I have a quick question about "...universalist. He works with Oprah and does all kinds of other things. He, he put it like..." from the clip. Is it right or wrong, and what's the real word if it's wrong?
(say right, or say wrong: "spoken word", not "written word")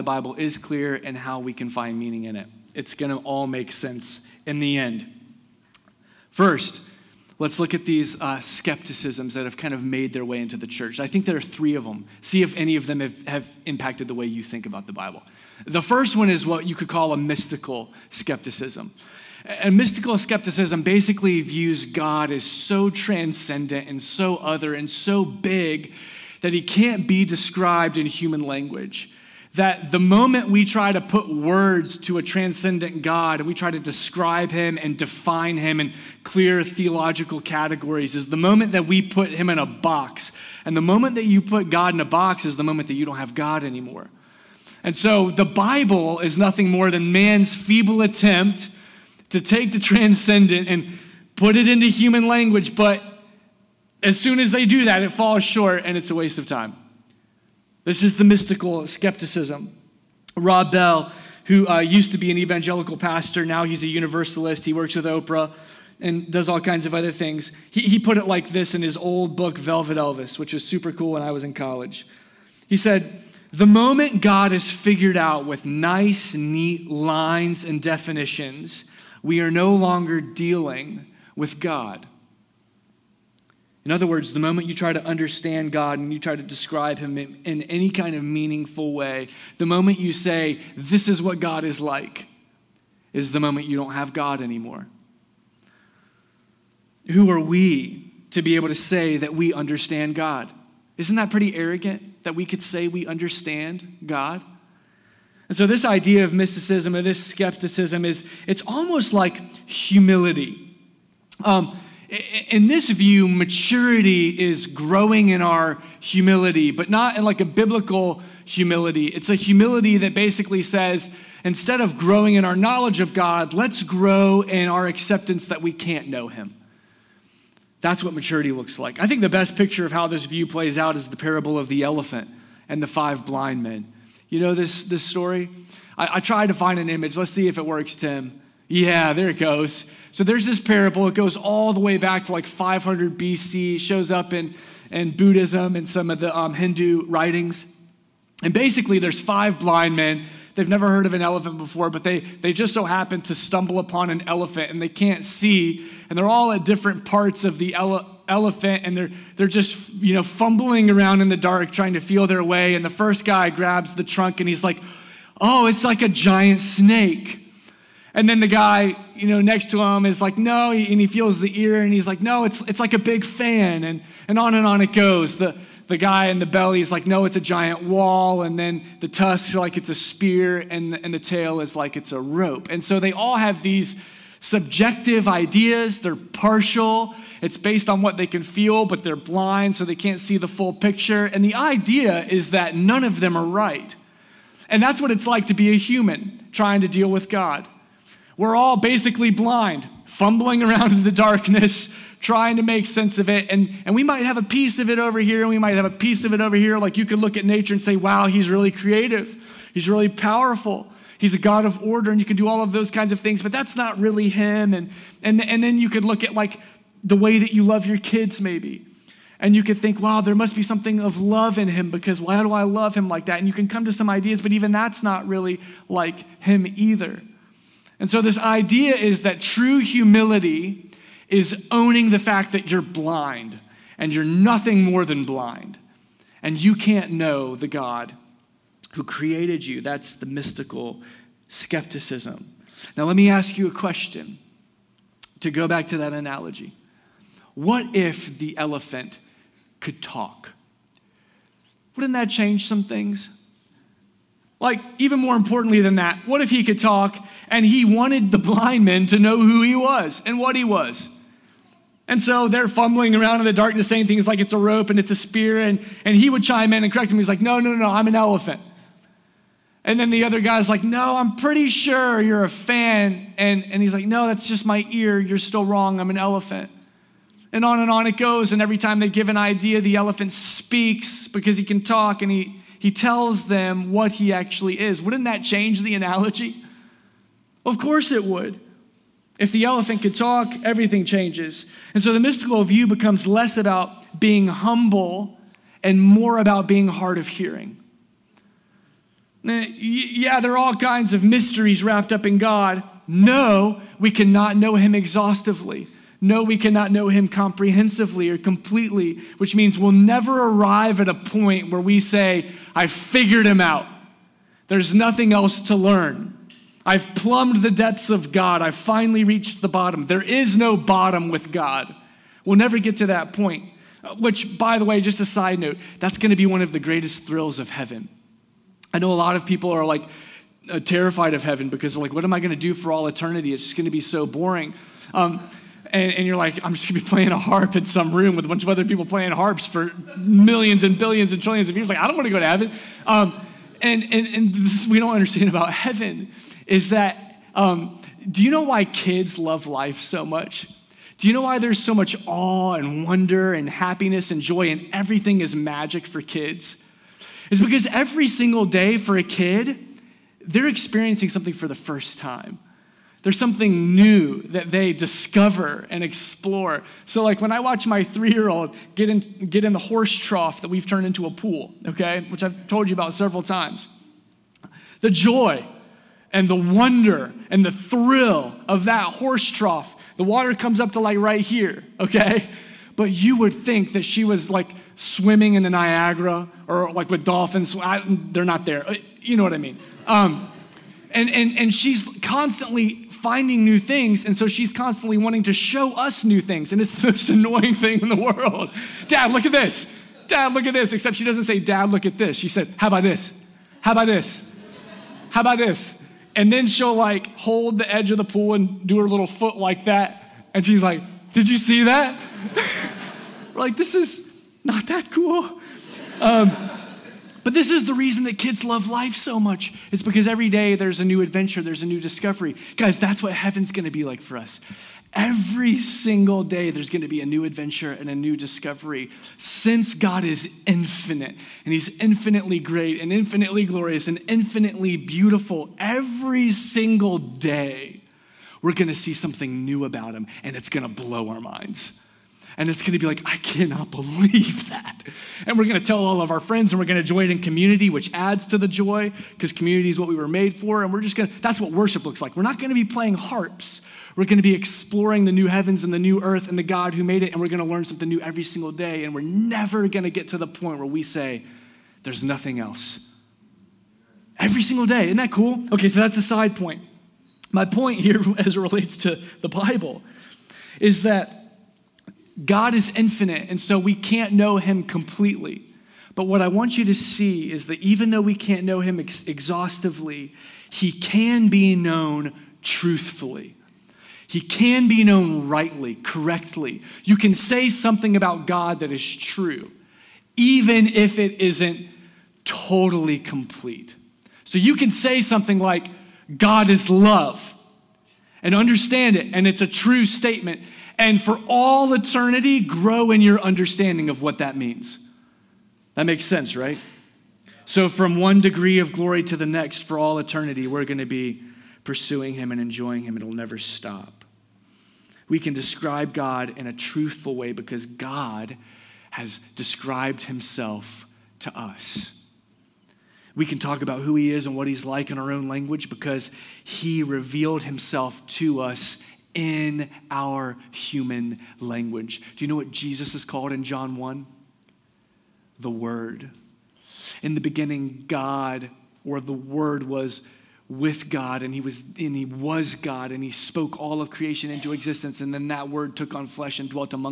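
right.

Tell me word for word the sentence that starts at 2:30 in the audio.
They've never heard of an elephant before, but they, they just so happen to stumble upon an elephant and they can't see.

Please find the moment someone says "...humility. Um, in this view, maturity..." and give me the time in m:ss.
1:49.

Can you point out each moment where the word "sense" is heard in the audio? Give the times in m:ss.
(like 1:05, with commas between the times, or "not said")
0:03, 3:22, 8:26.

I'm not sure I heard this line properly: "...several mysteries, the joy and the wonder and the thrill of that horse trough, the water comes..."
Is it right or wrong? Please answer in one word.
wrong.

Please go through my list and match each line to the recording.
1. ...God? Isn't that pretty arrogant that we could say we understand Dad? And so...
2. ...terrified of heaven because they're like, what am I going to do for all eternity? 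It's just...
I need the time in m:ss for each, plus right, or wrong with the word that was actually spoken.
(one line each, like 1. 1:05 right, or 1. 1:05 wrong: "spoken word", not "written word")
1. 1:40 wrong: "God", not "Dad"
2. 5:30 right.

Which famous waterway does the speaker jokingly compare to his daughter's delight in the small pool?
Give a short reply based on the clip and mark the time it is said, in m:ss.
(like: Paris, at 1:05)
Niagara, at 6:25.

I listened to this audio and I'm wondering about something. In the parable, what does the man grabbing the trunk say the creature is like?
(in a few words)
a giant snake.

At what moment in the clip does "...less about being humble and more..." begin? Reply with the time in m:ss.
4:53.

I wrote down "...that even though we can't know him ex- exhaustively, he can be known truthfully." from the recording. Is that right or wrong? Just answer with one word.
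right.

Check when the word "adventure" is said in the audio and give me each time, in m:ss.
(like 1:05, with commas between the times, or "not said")
7:01, 7:07.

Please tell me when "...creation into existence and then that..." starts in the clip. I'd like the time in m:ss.
9:04.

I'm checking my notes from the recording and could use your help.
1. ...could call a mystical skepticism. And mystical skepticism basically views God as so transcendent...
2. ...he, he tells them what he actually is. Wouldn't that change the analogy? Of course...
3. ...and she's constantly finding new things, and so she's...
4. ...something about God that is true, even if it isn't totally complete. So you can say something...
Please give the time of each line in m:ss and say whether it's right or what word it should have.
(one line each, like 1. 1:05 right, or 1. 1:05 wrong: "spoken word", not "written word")
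1. 0:16 right
2. 4:42 right
3. 6:31 right
4. 8:07 right.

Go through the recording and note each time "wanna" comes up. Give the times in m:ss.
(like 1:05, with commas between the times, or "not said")
5:42.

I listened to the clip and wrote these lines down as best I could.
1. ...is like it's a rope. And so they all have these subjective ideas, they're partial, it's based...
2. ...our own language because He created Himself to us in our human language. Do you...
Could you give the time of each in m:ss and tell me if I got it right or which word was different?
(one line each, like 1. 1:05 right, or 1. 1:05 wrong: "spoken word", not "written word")
1. 3:01 right
2. 8:45 wrong: "revealed", not "created".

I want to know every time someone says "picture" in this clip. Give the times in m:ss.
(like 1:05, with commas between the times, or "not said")
2:09, 3:10.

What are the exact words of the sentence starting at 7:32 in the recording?
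We're not going to be playing harps.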